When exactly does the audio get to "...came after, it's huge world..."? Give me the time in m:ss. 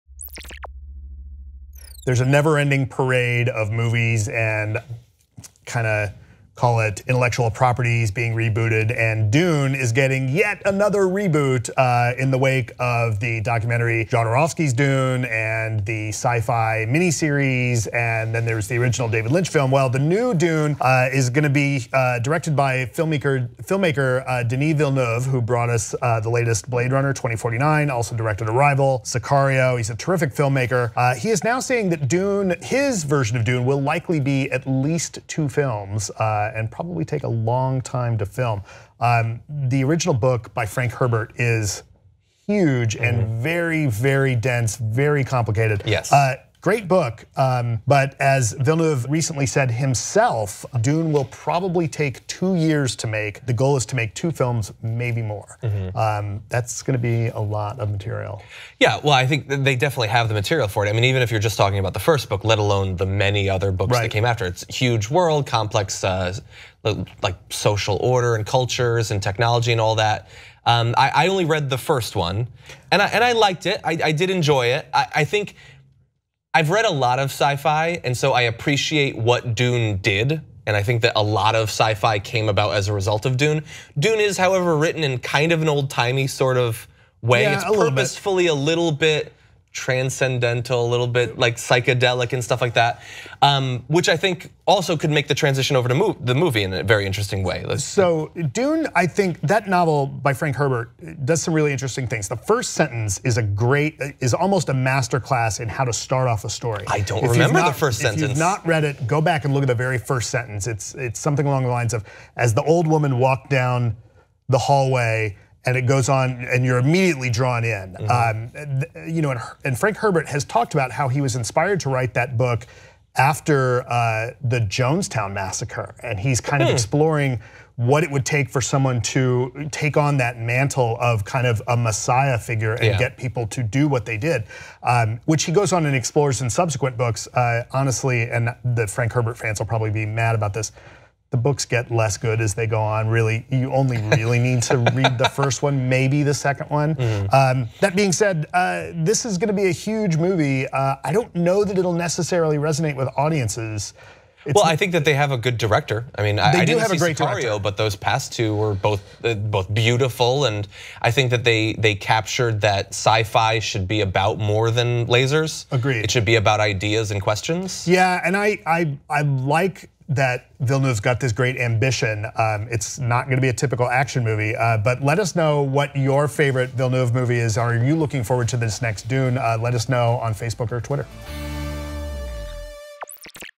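1:04.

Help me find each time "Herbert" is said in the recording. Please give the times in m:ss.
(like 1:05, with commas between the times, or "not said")
0:40, 1:40, 1:59, 2:19.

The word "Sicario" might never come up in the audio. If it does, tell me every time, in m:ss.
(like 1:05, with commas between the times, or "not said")
0:29, 2:37.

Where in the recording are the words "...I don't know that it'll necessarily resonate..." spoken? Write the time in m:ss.
2:31.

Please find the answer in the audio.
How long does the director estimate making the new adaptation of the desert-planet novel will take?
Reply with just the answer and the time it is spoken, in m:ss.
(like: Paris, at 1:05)
2 years, at 0:52.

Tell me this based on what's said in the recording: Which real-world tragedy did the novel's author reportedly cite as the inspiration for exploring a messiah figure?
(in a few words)
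Jonestown massacre.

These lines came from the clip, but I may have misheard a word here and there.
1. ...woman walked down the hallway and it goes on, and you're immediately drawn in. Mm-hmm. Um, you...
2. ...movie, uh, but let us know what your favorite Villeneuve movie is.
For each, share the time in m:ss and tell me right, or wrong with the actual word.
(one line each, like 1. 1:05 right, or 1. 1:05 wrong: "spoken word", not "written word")
1. 1:52 right
2. 2:54 right.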